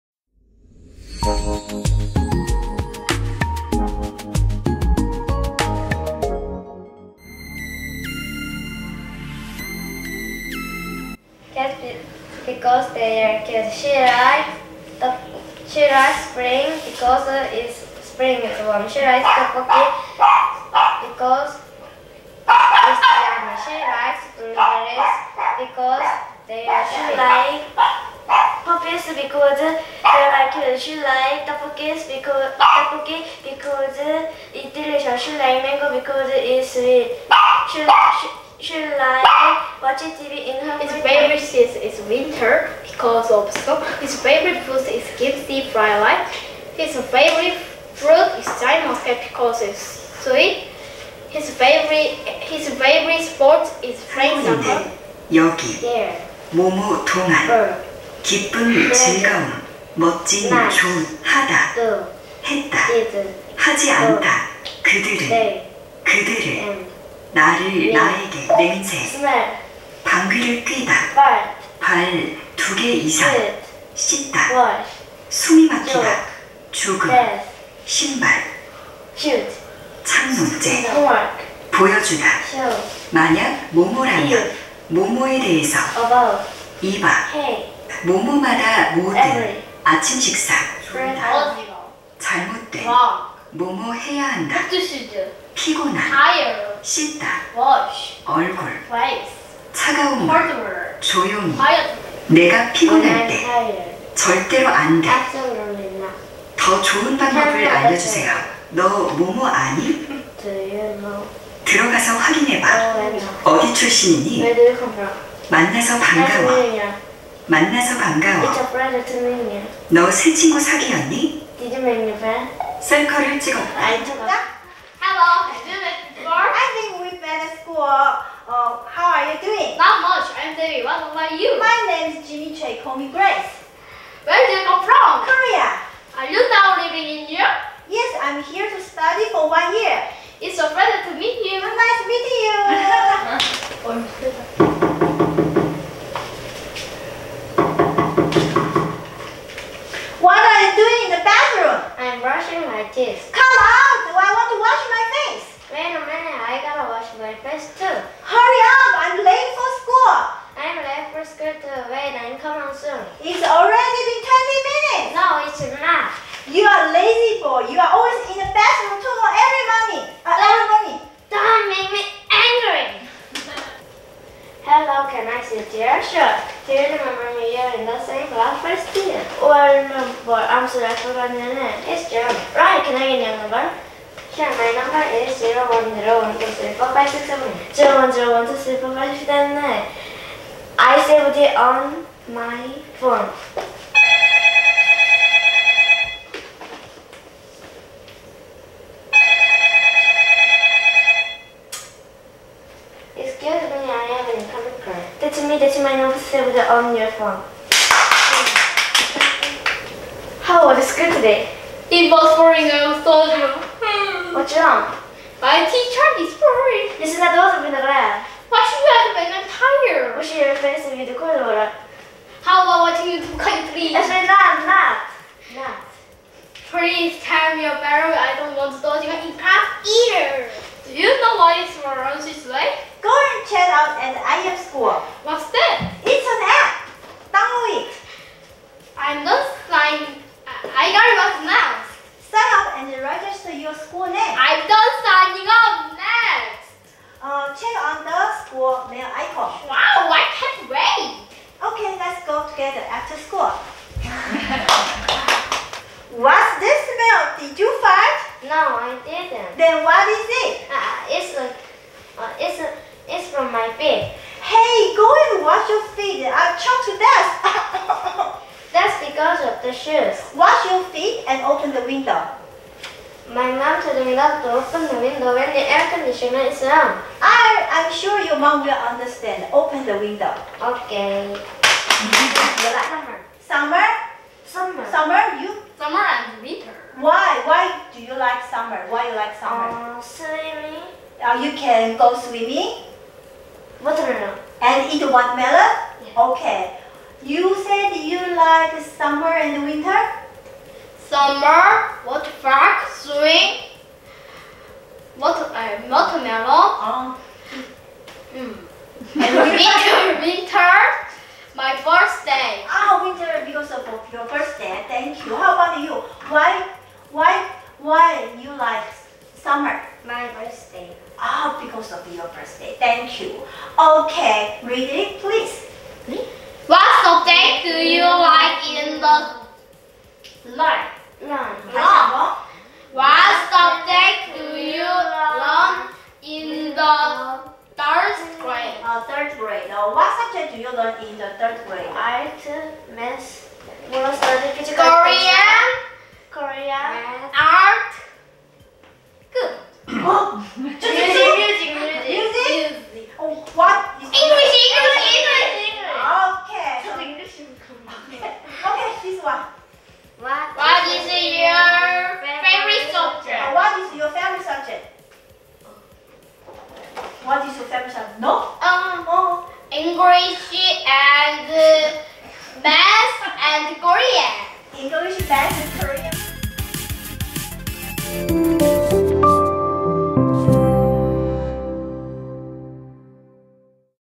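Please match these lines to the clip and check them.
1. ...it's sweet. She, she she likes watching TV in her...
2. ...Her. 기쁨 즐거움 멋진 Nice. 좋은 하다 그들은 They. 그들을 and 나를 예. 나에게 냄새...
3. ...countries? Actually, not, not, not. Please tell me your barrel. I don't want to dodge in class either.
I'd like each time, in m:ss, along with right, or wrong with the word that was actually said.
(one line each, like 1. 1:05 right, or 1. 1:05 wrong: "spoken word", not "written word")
1. 0:36 right
2. 0:57 right
3. 3:43 right.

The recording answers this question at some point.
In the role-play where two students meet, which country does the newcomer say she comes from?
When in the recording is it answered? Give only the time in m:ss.
2:15.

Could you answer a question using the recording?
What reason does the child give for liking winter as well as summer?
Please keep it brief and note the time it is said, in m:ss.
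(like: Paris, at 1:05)
my birthday, at 5:11.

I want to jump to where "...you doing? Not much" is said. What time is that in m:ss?
2:09.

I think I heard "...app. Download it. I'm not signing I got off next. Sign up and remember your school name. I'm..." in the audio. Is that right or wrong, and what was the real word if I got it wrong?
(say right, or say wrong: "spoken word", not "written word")
wrong: "register", not "remember".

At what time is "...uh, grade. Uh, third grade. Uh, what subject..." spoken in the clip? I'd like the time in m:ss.
5:38.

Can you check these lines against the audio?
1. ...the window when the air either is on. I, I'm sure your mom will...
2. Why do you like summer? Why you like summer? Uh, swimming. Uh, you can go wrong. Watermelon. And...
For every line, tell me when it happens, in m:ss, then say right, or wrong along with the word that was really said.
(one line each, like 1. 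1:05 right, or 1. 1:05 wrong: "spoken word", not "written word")
1. 4:34 wrong: "conditioner", not "either"
2. 4:47 wrong: "swimming", not "wrong".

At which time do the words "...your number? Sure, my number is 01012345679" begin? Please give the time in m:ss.
3:03.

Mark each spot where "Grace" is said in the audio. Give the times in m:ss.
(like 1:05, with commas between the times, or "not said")
2:13.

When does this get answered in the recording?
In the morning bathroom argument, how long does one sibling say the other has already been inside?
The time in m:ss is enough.
2:44.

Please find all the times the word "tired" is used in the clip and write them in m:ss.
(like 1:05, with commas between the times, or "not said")
1:36, 3:39.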